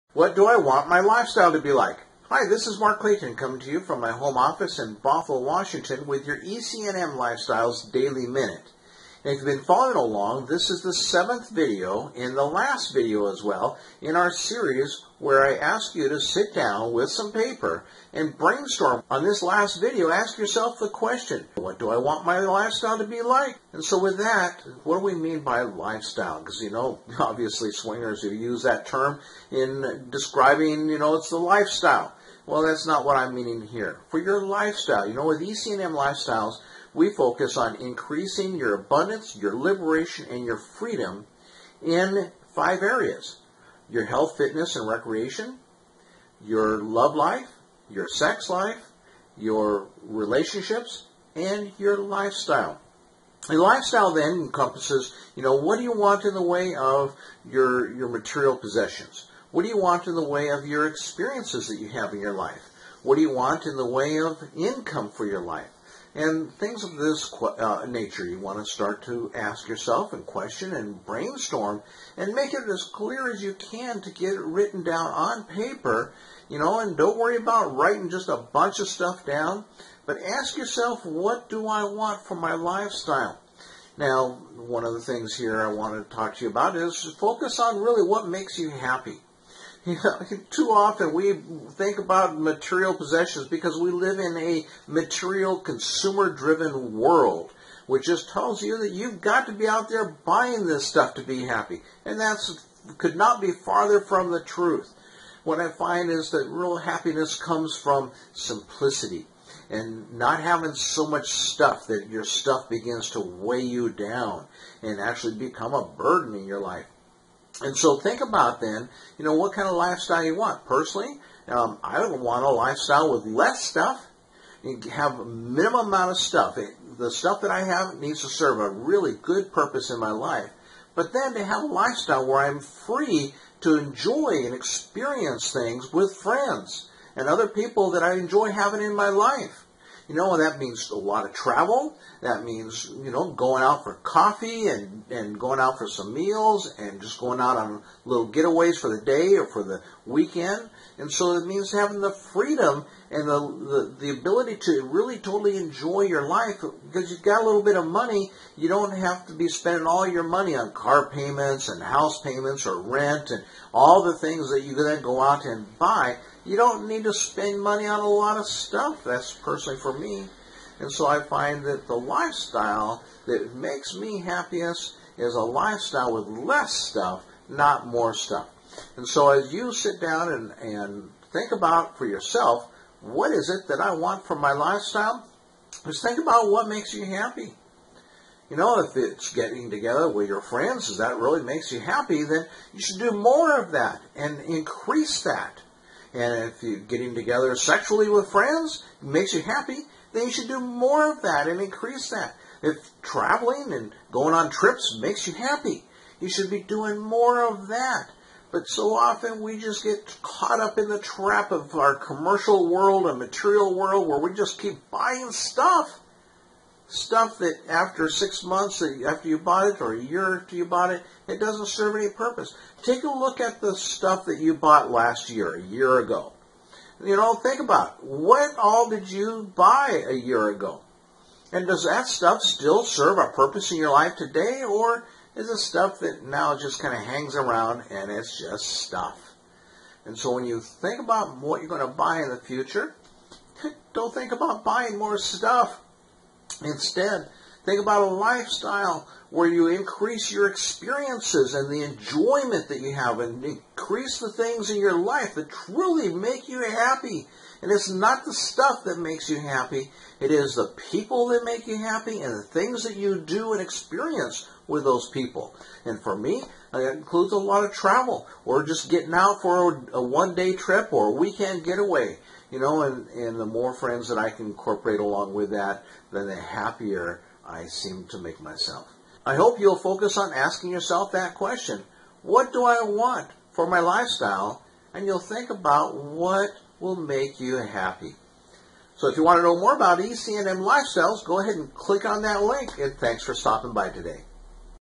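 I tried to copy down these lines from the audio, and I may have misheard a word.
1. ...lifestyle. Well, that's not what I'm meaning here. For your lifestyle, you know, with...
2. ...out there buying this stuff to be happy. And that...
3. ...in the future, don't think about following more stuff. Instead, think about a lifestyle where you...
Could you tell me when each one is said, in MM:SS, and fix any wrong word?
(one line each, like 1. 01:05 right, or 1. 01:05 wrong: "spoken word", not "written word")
1. 00:31 right
2. 01:39 right
3. 04:02 wrong: "buying", not "following".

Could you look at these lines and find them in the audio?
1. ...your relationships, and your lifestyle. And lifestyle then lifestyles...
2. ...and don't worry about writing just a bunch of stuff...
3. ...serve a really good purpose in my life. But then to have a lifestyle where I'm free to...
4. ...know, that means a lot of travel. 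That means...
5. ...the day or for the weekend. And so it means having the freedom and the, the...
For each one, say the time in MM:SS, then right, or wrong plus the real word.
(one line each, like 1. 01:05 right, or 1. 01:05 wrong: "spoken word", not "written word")
1. 00:49 wrong: "encompasses", not "lifestyles"
2. 01:16 right
3. 02:08 right
4. 02:20 right
5. 02:28 right.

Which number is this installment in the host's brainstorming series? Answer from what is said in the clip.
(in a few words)
seventh.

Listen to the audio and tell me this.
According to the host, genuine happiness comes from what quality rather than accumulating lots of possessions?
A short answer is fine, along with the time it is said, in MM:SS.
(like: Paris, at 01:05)
simplicity, at 01:48.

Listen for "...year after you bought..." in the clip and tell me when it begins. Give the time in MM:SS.
03:40.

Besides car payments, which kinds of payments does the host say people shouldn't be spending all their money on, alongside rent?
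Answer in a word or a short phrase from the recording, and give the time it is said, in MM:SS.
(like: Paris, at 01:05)
house payments, at 02:41.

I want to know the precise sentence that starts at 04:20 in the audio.
It is the people that make you happy and the things that you do and experience with those people.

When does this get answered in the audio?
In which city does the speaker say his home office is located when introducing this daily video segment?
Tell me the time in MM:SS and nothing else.
00:05.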